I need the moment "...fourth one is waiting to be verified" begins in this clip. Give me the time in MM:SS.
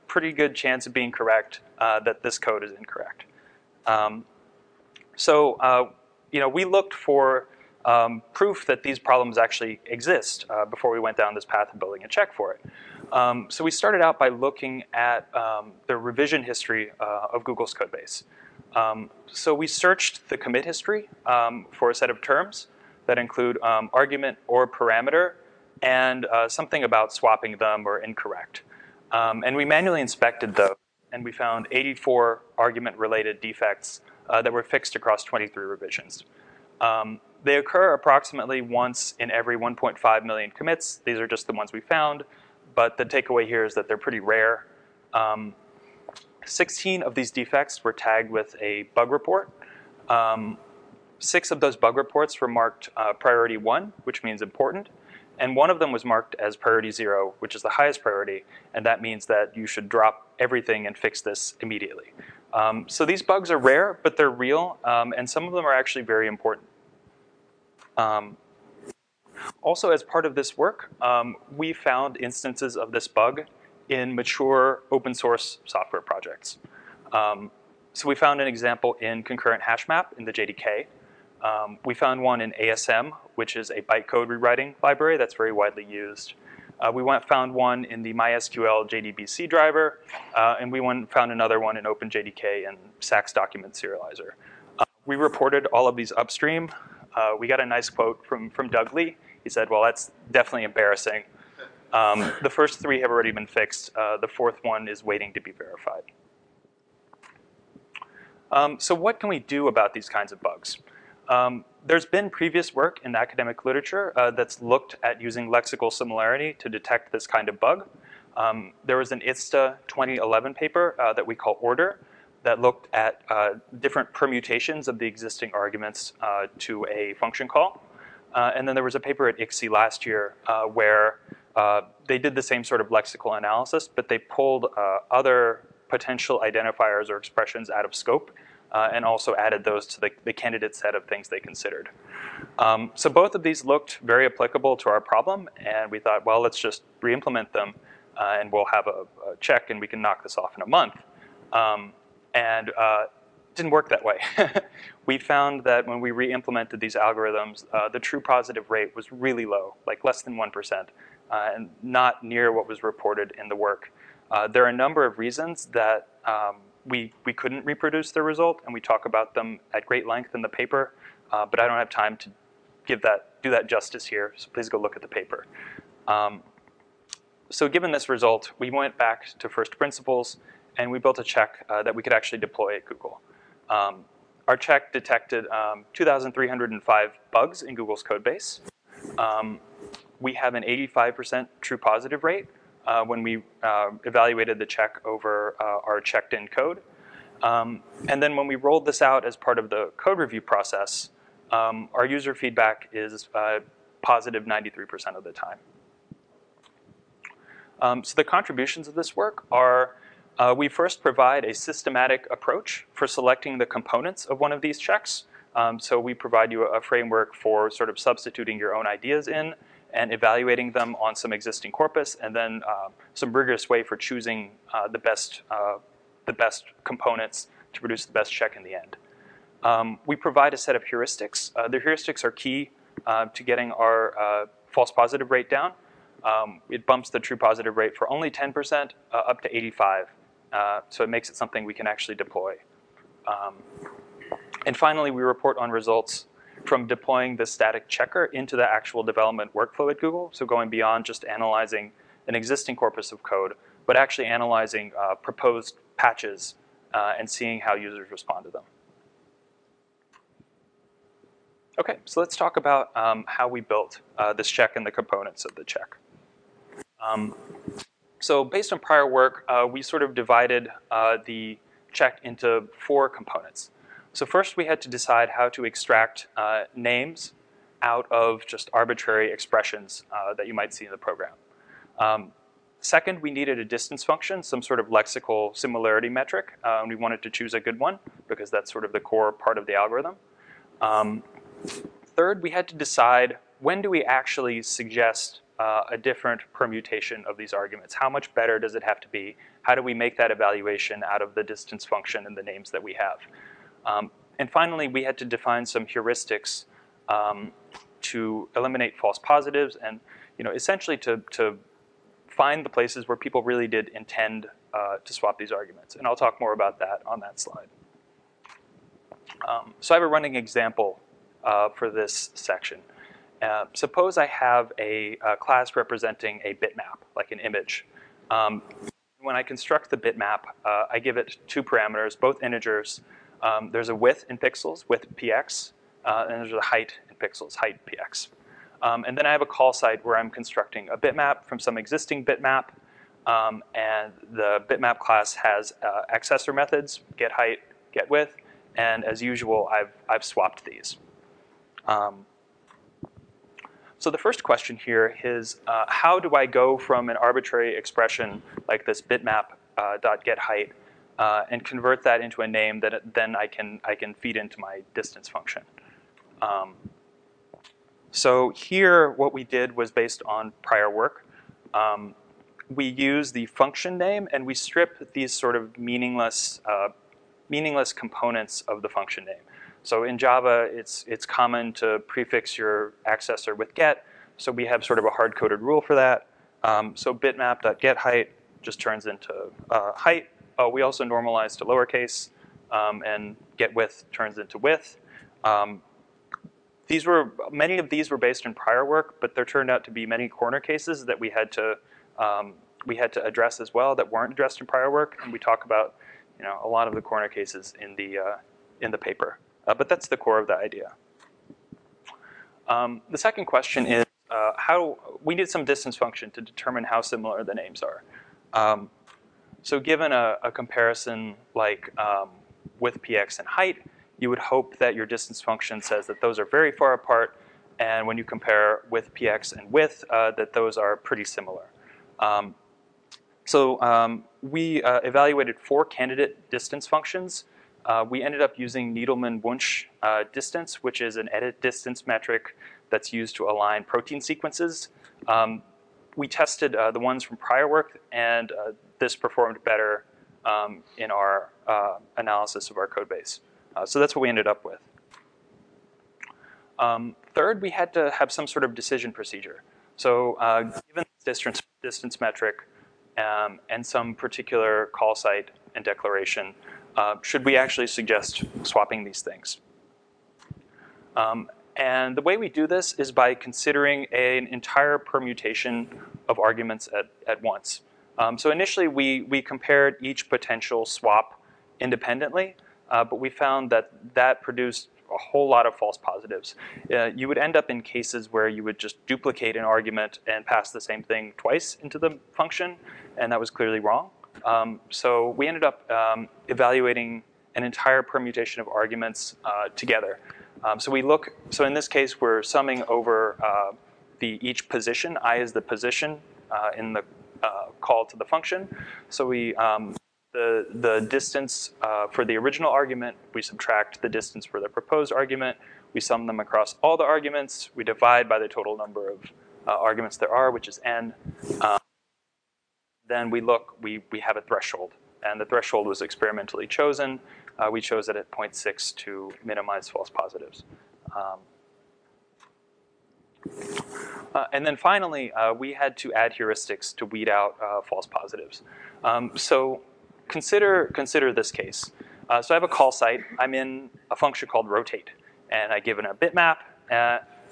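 01:44.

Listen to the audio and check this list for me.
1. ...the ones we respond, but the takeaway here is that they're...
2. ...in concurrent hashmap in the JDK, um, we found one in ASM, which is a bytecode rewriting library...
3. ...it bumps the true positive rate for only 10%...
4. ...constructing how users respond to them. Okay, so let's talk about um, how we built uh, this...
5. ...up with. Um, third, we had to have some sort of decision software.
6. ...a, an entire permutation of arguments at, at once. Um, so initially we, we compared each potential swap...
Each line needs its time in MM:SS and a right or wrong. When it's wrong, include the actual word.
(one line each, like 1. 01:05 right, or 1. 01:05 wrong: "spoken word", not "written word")
1. 00:41 wrong: "found", not "respond"
2. 01:19 right
3. 03:56 right
4. 04:17 wrong: "seeing", not "constructing"
5. 07:34 wrong: "procedure", not "software"
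6. 07:54 right.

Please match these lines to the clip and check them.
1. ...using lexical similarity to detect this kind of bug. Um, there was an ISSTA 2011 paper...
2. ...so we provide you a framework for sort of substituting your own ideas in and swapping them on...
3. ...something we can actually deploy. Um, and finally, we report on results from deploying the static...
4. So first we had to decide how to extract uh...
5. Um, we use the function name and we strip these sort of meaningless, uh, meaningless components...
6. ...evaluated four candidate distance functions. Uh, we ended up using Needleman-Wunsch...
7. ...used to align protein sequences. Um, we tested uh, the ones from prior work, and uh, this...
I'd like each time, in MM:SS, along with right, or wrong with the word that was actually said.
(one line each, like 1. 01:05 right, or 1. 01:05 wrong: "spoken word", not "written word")
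1. 01:55 right
2. 03:35 wrong: "evaluating", not "swapping"
3. 04:01 right
4. 04:34 right
5. 06:11 right
6. 07:15 right
7. 07:23 right.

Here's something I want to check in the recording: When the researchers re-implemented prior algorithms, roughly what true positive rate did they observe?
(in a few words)
less than 1%.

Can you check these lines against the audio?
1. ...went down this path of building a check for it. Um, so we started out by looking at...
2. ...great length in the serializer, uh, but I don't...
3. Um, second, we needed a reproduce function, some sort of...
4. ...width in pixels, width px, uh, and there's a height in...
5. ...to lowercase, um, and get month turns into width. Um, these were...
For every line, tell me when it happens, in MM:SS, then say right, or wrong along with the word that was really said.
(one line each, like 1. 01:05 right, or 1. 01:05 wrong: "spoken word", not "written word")
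1. 00:10 right
2. 02:49 wrong: "paper", not "serializer"
3. 04:41 wrong: "distance", not "reproduce"
4. 05:33 right
5. 06:31 wrong: "width", not "month".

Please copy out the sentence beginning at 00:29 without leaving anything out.
Um, and we manually inspected those and we found 84 argument related defects uh, that were fixed across 23 revisions.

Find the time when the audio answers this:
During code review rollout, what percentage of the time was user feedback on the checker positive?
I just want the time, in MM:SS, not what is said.
03:24.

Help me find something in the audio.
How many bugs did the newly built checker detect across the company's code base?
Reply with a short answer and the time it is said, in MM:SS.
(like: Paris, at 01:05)
2,305, at 03:05.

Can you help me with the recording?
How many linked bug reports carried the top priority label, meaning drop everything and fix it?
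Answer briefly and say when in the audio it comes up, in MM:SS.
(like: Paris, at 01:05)
1, at 00:55.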